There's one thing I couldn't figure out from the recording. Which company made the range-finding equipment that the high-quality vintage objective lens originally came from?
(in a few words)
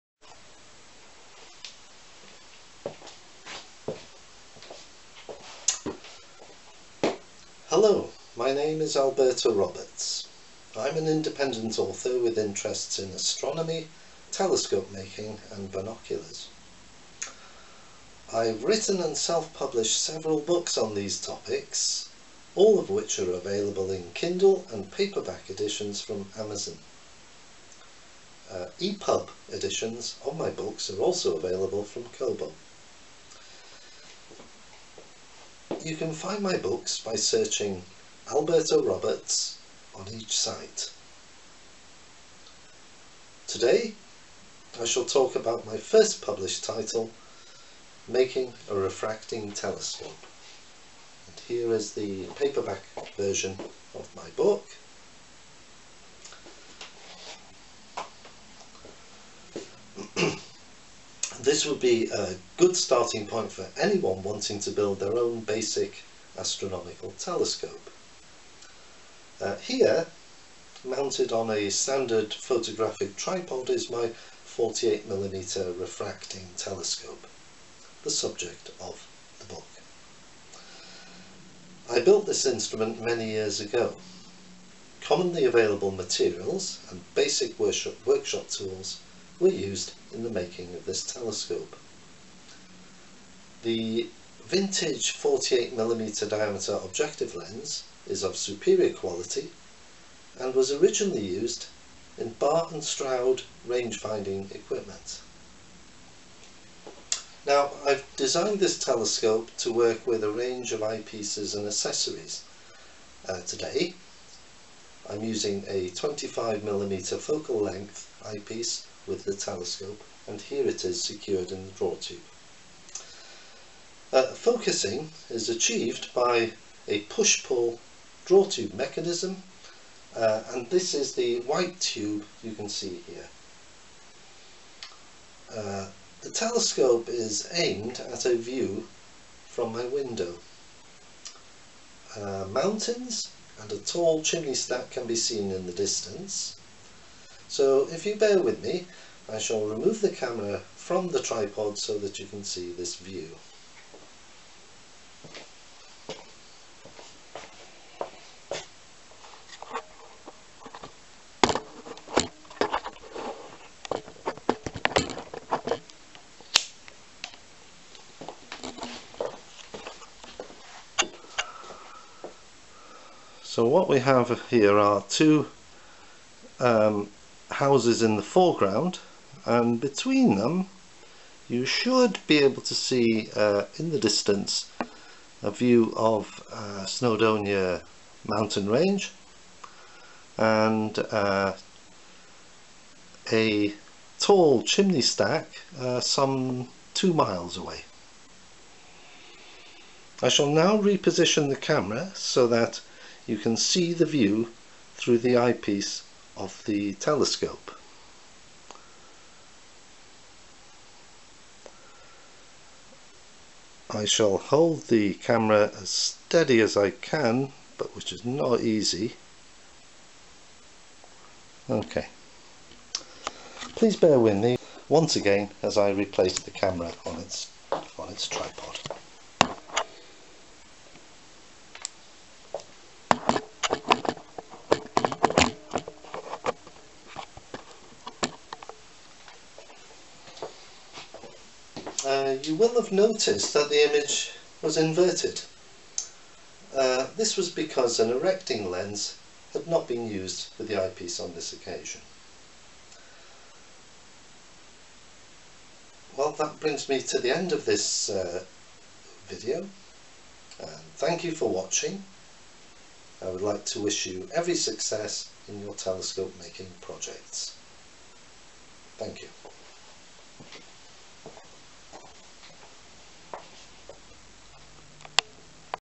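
Barr and Stroud.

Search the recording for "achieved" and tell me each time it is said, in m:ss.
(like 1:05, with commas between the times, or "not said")
2:05.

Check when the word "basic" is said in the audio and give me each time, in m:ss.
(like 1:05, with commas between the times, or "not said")
1:05, 1:27.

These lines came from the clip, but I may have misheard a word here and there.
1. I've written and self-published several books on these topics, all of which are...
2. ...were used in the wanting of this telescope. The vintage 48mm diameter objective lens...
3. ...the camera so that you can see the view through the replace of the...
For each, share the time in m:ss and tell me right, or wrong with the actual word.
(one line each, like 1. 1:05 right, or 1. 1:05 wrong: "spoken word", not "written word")
1. 0:18 right
2. 1:29 wrong: "making", not "wanting"
3. 3:21 wrong: "eyepiece", not "replace".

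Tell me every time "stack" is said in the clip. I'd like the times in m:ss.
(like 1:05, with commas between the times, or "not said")
2:24, 3:15.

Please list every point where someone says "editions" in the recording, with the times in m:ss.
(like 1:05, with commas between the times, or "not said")
0:25, 0:29.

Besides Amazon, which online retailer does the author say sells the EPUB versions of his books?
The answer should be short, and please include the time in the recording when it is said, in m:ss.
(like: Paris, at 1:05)
Kobo, at 0:32.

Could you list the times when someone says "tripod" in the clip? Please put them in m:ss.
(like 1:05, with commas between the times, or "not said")
1:13, 2:31, 3:48.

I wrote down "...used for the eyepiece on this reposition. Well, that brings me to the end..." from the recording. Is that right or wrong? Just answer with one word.
wrong.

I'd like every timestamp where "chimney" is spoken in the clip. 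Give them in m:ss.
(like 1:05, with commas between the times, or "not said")
2:24, 3:14.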